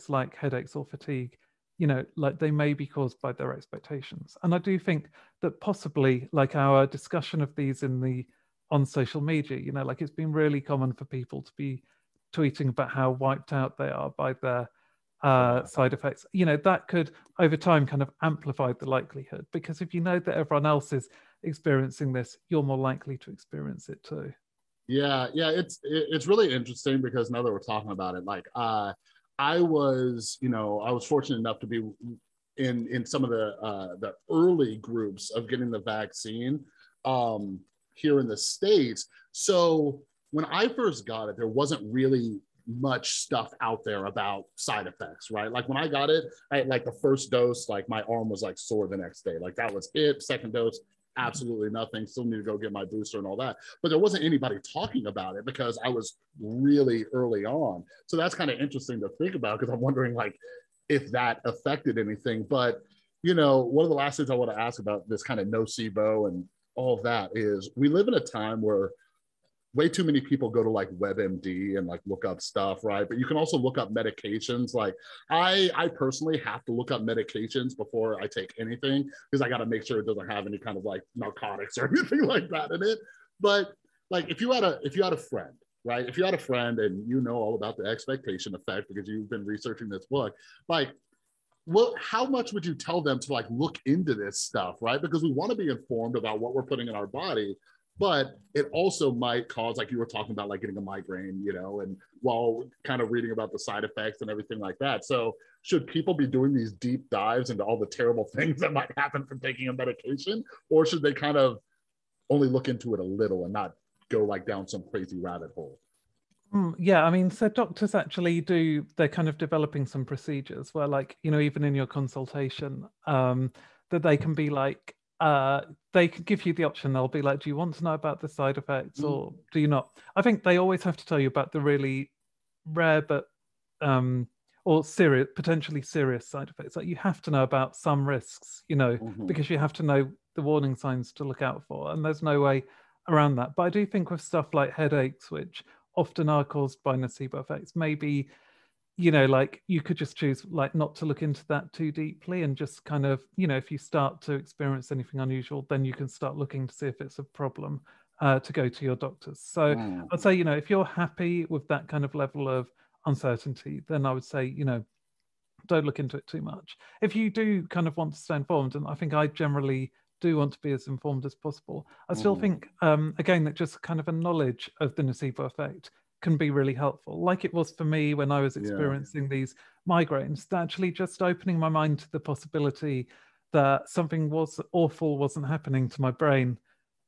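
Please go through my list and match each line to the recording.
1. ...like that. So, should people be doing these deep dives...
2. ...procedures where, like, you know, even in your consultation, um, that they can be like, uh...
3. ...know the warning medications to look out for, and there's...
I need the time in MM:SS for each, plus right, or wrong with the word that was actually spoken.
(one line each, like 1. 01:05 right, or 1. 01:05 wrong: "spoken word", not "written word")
1. 01:44 right
2. 02:00 right
3. 02:19 wrong: "signs", not "medications".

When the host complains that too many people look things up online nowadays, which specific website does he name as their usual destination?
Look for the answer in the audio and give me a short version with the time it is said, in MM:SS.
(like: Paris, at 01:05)
WebMD, at 01:10.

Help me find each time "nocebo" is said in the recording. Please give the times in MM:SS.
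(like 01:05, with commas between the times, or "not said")
01:05, 02:26, 02:55.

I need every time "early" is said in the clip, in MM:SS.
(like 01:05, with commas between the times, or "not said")
00:34, 00:57.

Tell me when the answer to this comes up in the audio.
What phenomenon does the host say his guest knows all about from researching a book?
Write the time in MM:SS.
01:27.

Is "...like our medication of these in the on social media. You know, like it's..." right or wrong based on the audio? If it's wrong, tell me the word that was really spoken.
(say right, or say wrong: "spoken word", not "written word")
wrong: "discussion", not "medication".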